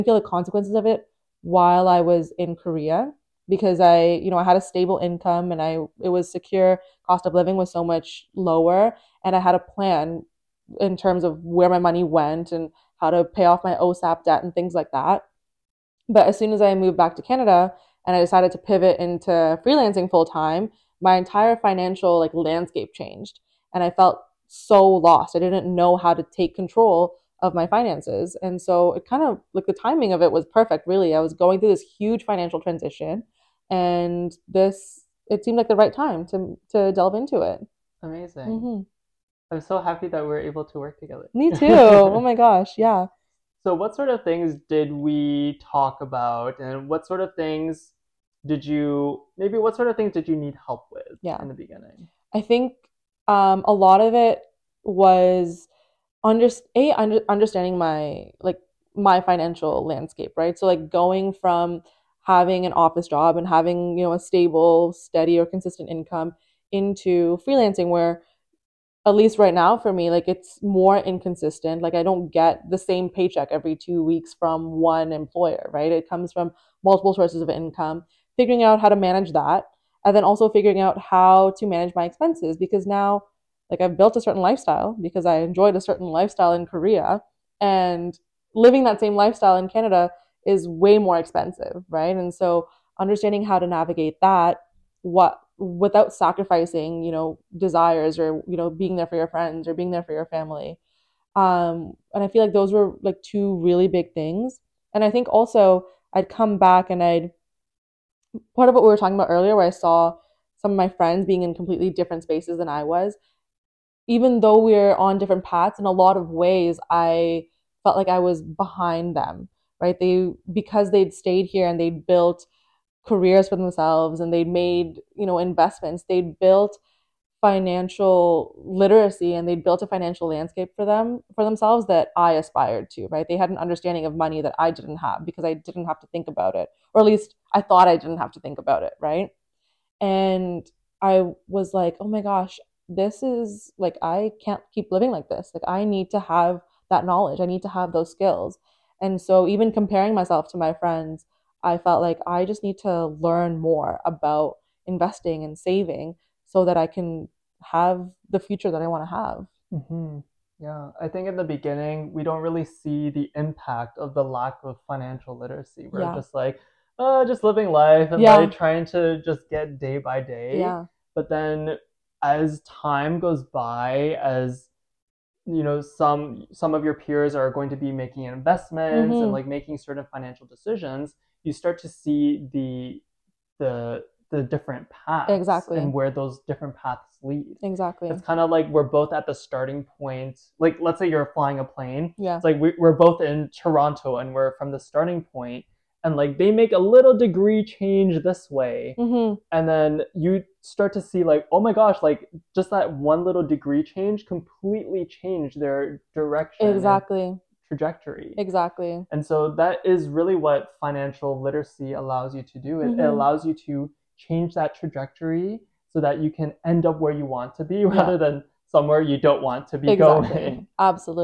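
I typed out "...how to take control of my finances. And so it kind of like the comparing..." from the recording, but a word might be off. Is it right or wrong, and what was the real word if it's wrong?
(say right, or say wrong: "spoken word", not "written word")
wrong: "timing", not "comparing".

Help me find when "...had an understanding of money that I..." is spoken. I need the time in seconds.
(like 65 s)
133 s.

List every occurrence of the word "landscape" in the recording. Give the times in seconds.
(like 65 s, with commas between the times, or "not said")
22 s, 59 s, 130 s.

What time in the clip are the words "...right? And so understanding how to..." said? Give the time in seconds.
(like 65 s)
91 s.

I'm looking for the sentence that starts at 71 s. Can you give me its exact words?
Like I don't get the same paycheck every two weeks from one employer, right?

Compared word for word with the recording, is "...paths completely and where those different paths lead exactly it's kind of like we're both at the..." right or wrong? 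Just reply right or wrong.
wrong.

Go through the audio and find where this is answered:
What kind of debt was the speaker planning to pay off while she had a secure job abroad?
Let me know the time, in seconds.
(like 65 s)
13 s.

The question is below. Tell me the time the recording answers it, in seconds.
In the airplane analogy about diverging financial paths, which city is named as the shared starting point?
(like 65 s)
193 s.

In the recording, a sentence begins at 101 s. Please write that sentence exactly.
Um and I feel like those were like two really big things.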